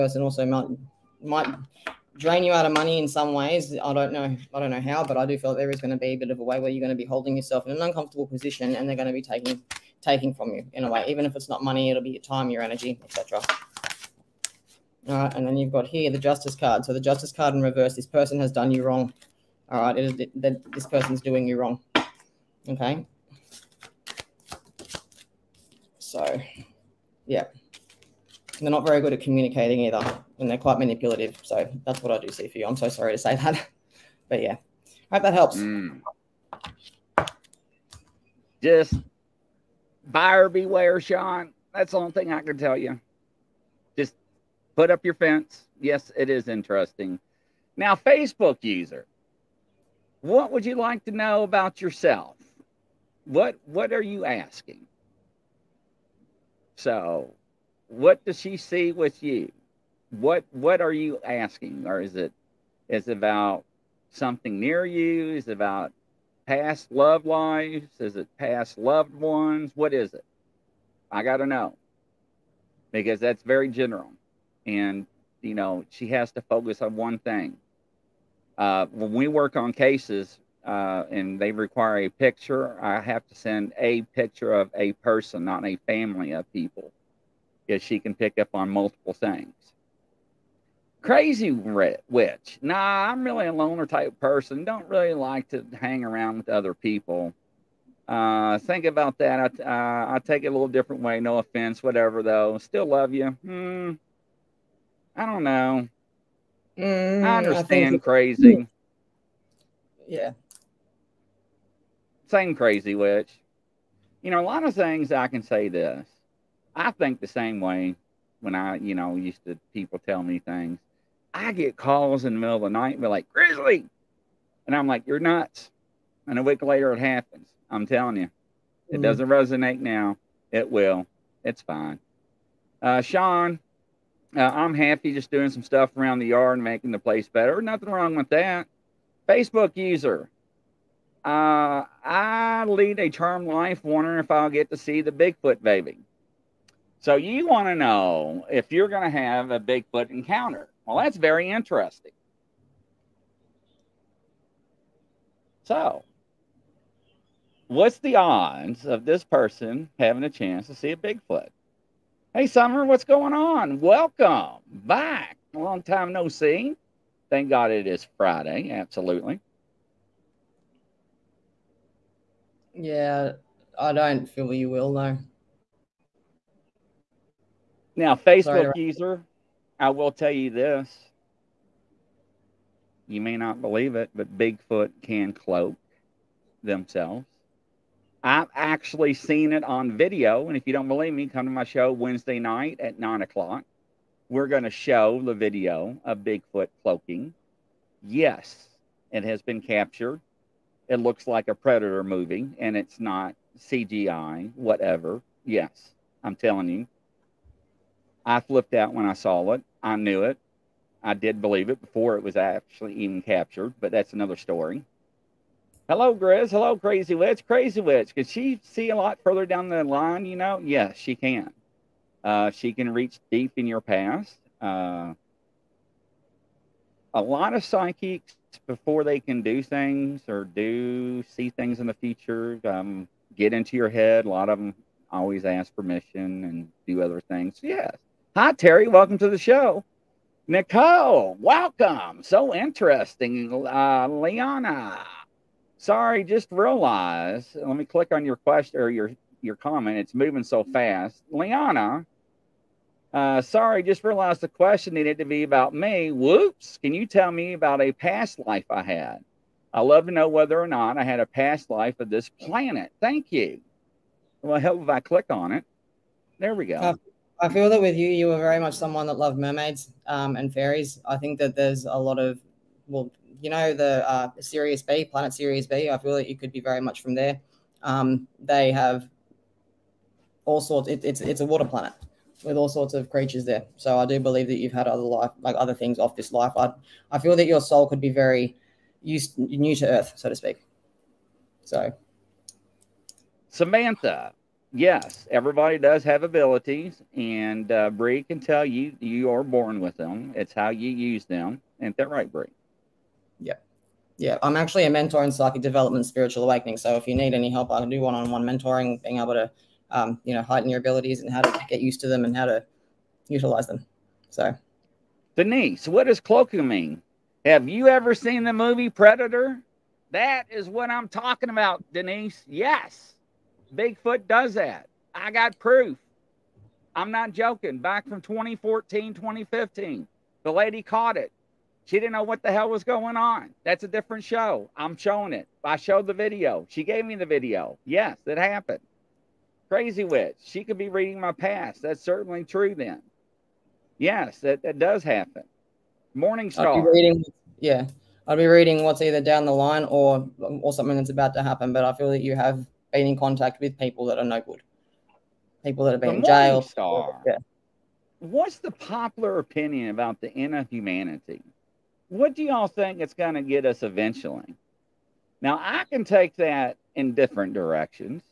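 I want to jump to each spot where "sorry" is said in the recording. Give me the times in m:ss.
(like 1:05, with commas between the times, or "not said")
0:32, 2:58, 4:05, 4:13.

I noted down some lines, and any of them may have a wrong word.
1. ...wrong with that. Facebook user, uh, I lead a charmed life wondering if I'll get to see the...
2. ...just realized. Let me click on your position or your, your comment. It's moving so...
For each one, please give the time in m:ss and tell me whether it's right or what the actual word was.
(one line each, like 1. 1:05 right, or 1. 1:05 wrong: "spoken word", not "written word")
1. 2:17 right
2. 4:06 wrong: "question", not "position".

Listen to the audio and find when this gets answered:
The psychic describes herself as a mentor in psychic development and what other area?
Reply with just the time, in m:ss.
5:06.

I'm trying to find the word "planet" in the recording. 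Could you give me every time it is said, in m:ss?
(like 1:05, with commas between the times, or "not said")
4:22, 4:35, 4:41.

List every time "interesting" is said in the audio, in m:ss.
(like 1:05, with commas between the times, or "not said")
0:46, 2:31, 4:02.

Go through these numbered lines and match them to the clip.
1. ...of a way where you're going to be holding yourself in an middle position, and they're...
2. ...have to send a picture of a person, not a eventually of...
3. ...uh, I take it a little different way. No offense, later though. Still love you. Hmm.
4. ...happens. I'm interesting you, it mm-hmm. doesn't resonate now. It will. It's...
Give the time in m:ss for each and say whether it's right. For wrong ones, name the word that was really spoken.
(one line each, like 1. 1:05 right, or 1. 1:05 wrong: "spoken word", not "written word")
1. 0:06 wrong: "uncomfortable", not "middle"
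2. 1:22 wrong: "family", not "eventually"
3. 1:39 wrong: "whatever", not "later"
4. 2:06 wrong: "telling", not "interesting".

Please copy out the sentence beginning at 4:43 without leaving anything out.
So I do believe that you've had other life, like other things off this life.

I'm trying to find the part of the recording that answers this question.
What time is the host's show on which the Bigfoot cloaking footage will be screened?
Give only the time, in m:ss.
3:12.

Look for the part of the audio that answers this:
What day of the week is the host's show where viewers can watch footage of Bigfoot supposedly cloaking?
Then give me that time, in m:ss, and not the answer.
3:11.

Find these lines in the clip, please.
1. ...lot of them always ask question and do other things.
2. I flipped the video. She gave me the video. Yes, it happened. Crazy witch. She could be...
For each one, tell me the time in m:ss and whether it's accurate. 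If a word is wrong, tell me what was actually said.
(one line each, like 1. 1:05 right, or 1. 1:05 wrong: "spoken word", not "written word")
1. 3:54 wrong: "permission", not "question"
2. 5:35 wrong: "showed", not "flipped".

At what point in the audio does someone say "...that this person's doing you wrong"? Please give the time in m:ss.
0:20.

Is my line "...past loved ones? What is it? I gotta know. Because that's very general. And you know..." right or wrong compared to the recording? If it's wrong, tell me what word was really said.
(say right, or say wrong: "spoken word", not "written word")
right.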